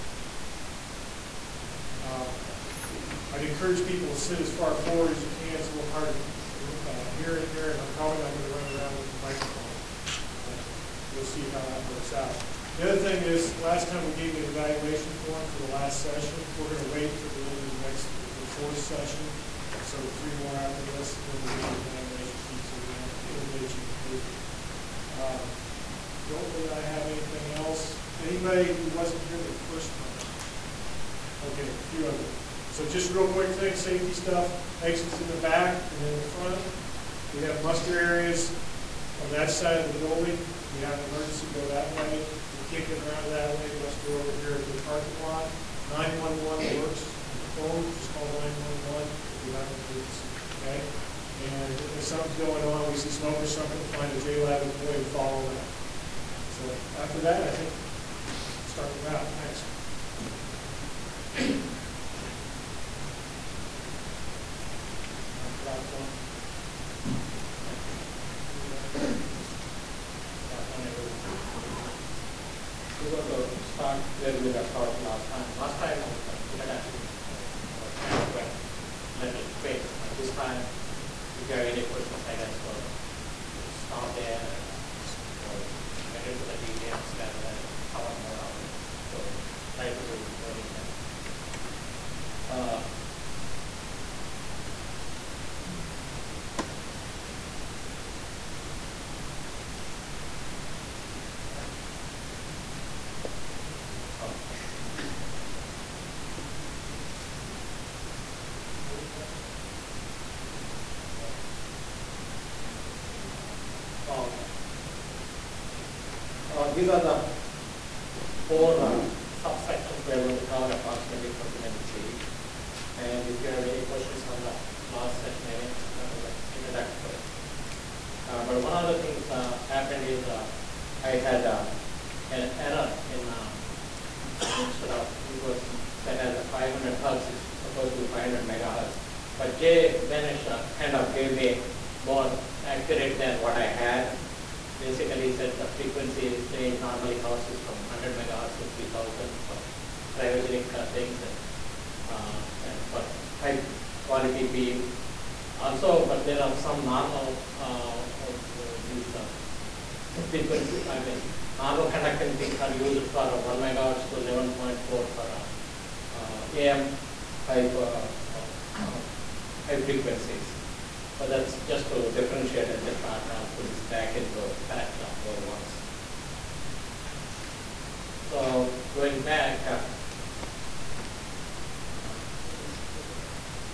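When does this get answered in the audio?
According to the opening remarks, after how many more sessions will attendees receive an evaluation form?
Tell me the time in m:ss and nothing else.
0:19.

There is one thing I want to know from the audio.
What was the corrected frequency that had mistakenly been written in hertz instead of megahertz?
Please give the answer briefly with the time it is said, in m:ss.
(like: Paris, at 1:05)
500 megahertz, at 2:18.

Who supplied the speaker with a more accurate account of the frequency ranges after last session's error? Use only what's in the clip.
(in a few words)
Jay Benesch.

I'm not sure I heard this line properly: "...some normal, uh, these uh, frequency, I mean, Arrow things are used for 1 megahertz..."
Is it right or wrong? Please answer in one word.
right.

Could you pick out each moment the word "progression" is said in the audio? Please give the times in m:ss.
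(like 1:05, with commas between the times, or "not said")
not said.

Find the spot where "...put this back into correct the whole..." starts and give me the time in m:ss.
2:53.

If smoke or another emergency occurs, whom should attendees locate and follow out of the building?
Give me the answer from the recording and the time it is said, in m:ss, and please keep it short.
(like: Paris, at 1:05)
a JLab employee, at 0:54.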